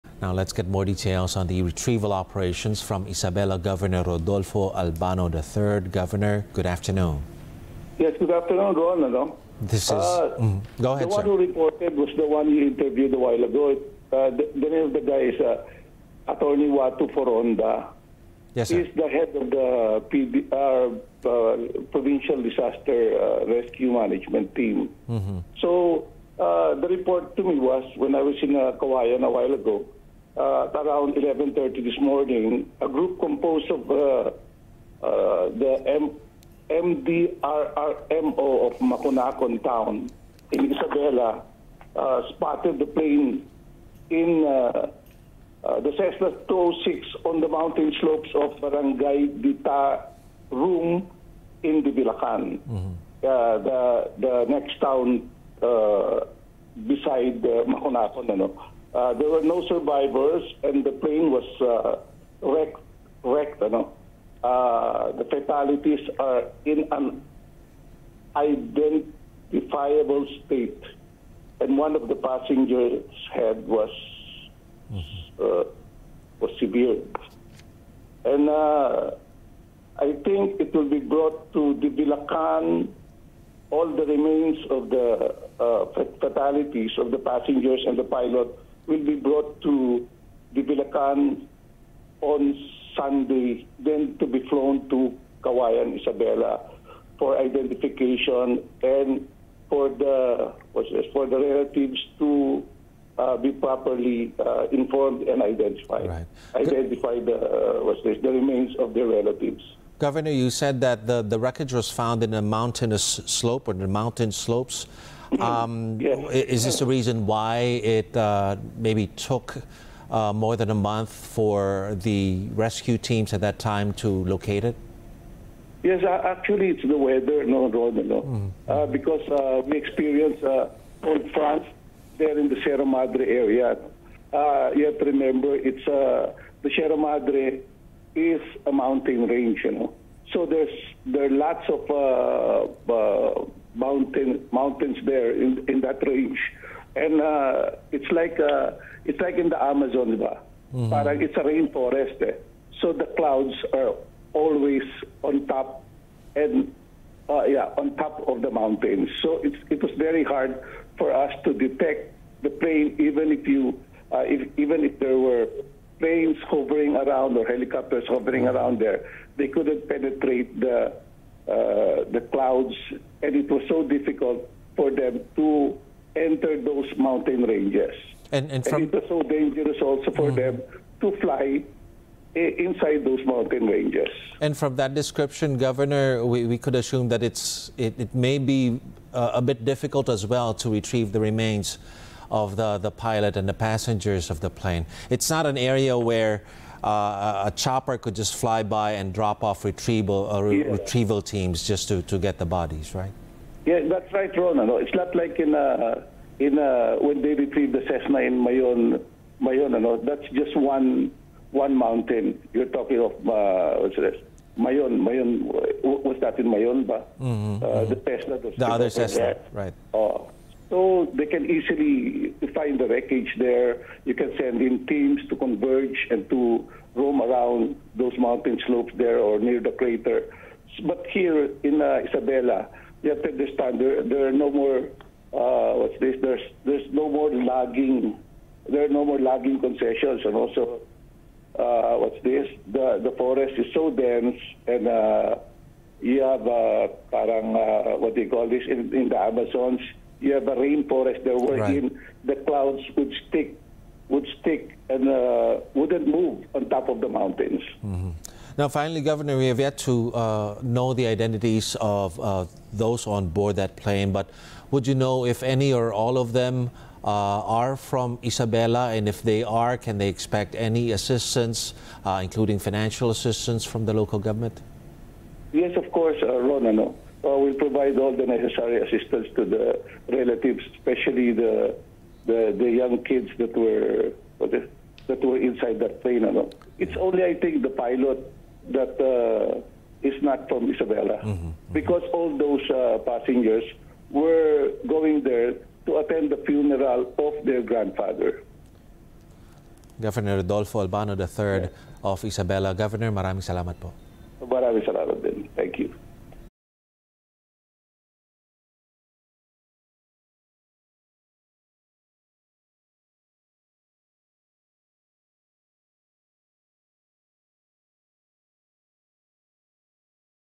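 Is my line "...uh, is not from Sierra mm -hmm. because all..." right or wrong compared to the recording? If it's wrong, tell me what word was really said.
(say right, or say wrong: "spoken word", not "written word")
wrong: "Isabela", not "Sierra".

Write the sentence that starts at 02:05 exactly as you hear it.
Yes, actually, it's the weather, no, no, Mm.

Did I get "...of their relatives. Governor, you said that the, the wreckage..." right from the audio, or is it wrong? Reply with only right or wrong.
right.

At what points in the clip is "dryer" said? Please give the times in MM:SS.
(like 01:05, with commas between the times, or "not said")
not said.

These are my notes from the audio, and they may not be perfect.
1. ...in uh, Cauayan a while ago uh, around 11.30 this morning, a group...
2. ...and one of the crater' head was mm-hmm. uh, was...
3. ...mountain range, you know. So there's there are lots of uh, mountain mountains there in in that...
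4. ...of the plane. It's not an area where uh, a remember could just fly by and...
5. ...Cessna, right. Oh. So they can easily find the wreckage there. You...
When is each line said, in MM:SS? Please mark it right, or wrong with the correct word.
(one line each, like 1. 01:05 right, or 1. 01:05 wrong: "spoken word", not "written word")
1. 00:28 right
2. 01:11 wrong: "passengers", not "crater"
3. 02:18 right
4. 03:14 wrong: "chopper", not "remember"
5. 03:38 right.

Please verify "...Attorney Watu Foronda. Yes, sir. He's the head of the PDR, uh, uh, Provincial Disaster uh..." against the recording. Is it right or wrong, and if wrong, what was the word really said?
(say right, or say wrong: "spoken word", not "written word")
right.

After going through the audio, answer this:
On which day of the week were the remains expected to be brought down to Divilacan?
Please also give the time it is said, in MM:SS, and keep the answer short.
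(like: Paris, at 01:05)
Sunday, at 01:32.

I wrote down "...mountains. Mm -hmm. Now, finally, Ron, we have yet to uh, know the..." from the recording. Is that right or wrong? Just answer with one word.
wrong.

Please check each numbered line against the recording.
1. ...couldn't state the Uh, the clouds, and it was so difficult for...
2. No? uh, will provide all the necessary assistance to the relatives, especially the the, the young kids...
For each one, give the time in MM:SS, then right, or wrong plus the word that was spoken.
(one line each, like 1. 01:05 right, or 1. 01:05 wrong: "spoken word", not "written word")
1. 02:49 wrong: "penetrate", not "state"
2. 04:36 right.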